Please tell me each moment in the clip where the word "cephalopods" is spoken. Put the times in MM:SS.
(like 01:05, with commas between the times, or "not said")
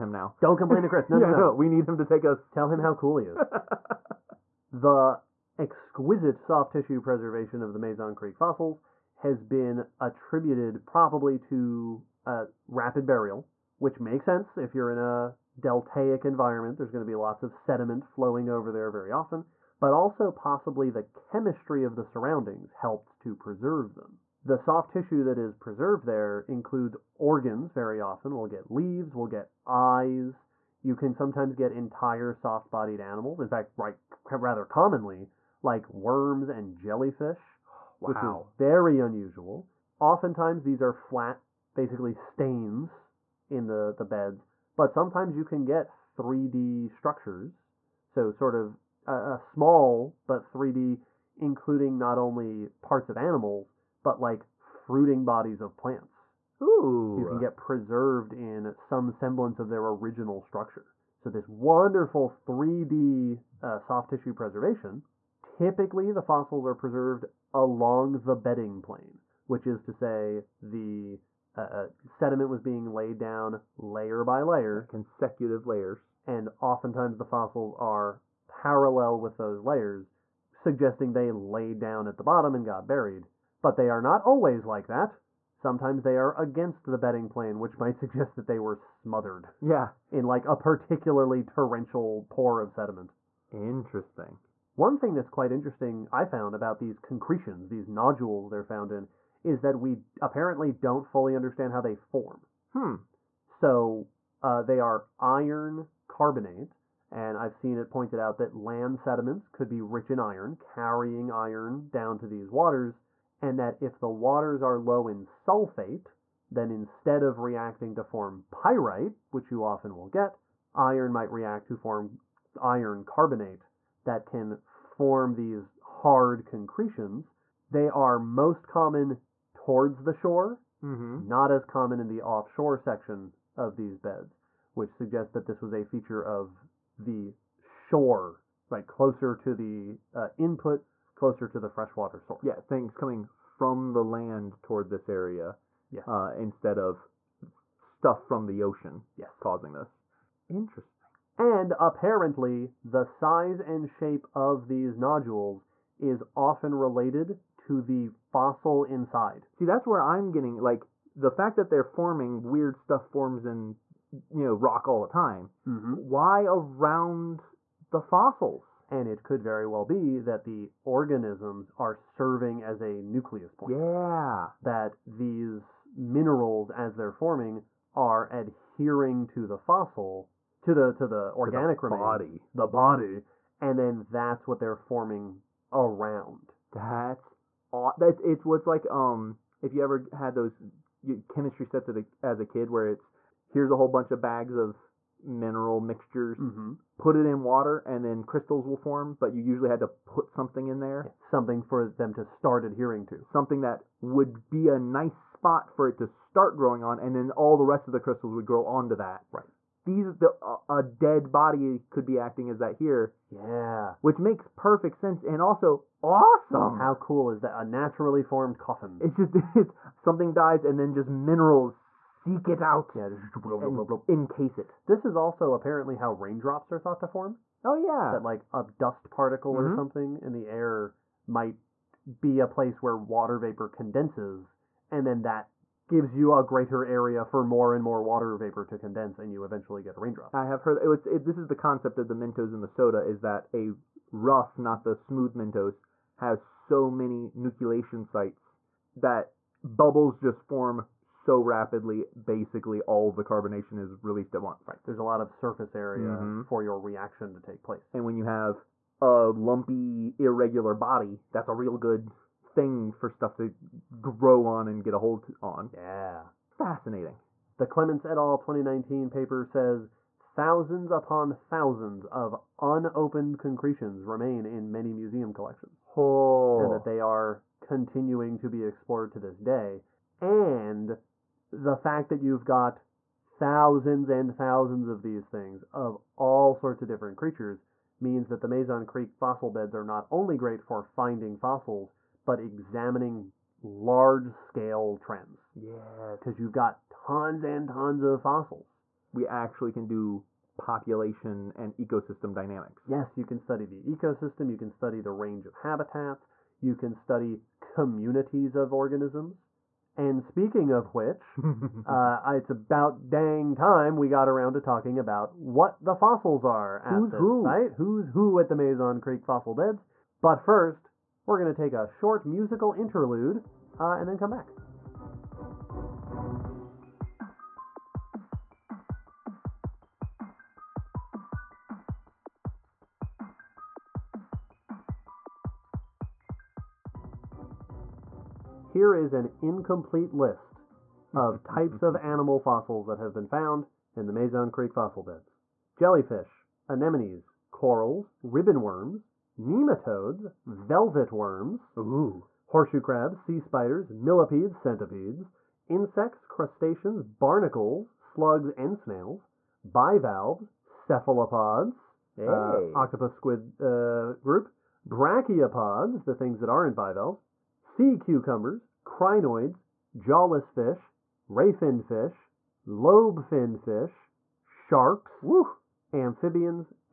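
06:00.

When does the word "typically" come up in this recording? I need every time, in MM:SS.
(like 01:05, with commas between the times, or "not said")
01:05.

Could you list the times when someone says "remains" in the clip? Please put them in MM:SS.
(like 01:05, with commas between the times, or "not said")
03:01, 04:34.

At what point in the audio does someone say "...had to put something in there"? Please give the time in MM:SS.
03:19.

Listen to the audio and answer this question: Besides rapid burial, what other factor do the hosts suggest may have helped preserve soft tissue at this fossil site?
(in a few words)
chemistry of the surroundings.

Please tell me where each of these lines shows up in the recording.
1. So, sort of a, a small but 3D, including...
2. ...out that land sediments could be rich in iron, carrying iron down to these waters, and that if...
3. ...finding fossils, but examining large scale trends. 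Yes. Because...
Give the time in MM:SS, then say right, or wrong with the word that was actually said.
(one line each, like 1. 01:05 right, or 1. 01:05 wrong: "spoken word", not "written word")
1. 00:48 right
2. 01:48 right
3. 04:50 right.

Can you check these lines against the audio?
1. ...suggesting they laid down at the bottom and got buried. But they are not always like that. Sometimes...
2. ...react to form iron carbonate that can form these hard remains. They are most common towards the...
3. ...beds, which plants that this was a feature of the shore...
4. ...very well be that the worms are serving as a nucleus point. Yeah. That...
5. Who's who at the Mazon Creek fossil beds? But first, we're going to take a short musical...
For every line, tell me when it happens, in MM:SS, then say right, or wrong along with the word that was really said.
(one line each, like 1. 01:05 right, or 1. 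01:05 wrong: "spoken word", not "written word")
1. 01:20 right
2. 02:01 wrong: "concretions", not "remains"
3. 02:13 wrong: "suggests", not "plants"
4. 02:49 wrong: "organisms", not "worms"
5. 05:17 right.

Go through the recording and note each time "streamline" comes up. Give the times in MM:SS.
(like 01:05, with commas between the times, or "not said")
not said.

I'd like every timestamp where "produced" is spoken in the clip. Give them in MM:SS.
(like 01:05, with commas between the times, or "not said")
not said.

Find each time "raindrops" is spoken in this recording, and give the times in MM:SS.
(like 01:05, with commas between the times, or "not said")
03:46, 04:00.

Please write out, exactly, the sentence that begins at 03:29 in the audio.
Right these the a dead body could be acting as that here.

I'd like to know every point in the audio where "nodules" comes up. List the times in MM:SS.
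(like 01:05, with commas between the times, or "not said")
01:37, 02:34.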